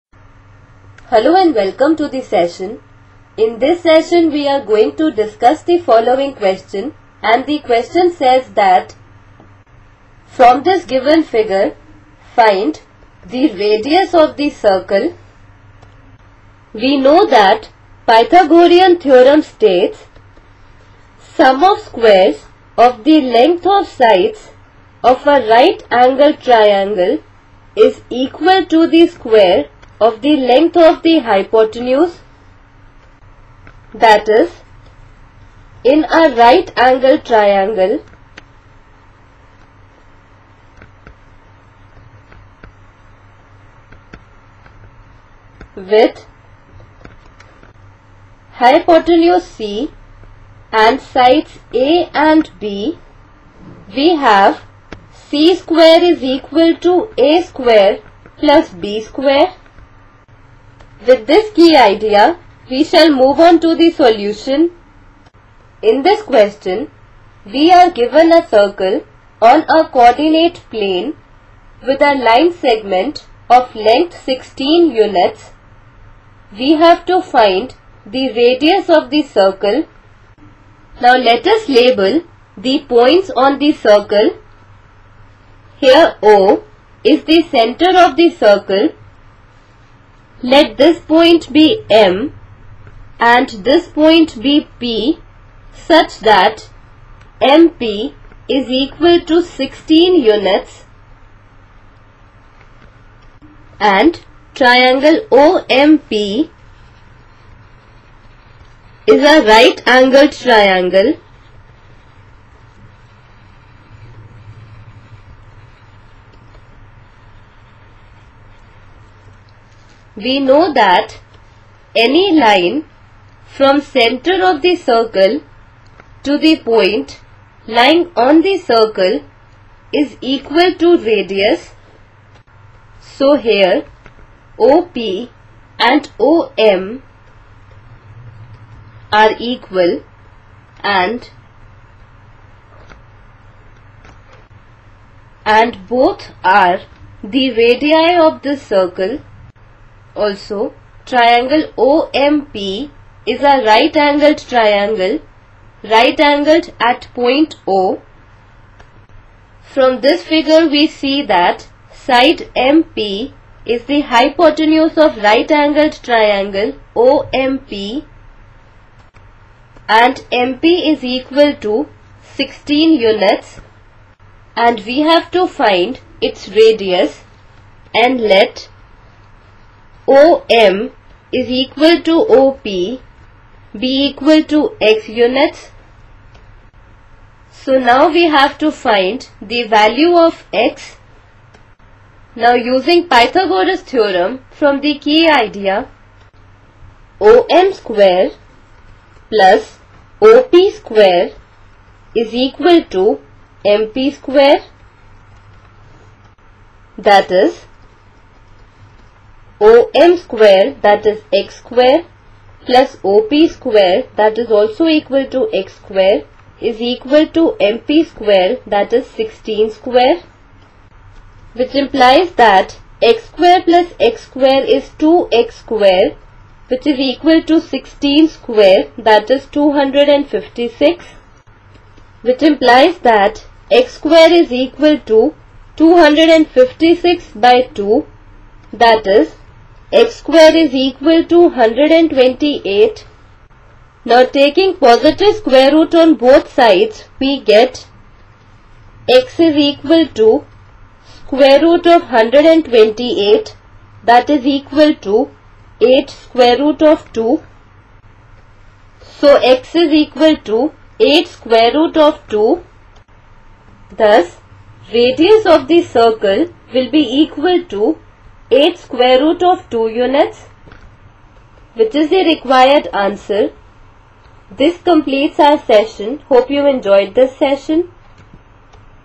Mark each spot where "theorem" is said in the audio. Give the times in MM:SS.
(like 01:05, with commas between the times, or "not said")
00:19, 03:13.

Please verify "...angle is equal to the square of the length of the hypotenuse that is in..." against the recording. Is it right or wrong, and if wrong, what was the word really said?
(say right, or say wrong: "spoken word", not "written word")
wrong: "triangle", not "angle".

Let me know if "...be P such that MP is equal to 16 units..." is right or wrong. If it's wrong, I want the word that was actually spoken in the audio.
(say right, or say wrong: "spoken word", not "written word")
right.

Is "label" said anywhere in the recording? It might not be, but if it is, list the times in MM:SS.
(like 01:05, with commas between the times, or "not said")
01:21.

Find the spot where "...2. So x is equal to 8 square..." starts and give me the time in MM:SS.
04:17.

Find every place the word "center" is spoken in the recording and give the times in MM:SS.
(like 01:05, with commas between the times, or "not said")
01:27, 02:03.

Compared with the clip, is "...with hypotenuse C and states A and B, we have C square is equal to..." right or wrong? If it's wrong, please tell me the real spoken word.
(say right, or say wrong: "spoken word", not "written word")
wrong: "sides", not "states".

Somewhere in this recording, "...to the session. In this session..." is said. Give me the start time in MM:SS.
00:01.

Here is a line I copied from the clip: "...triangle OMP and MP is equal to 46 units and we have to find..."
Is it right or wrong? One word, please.
wrong.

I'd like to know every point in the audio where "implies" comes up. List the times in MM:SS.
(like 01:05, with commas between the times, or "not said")
03:41, 03:52.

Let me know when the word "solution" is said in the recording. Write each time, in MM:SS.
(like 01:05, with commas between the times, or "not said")
01:03.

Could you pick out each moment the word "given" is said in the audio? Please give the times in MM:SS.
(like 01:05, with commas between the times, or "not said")
00:10, 01:07.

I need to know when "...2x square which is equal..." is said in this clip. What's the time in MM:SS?
03:45.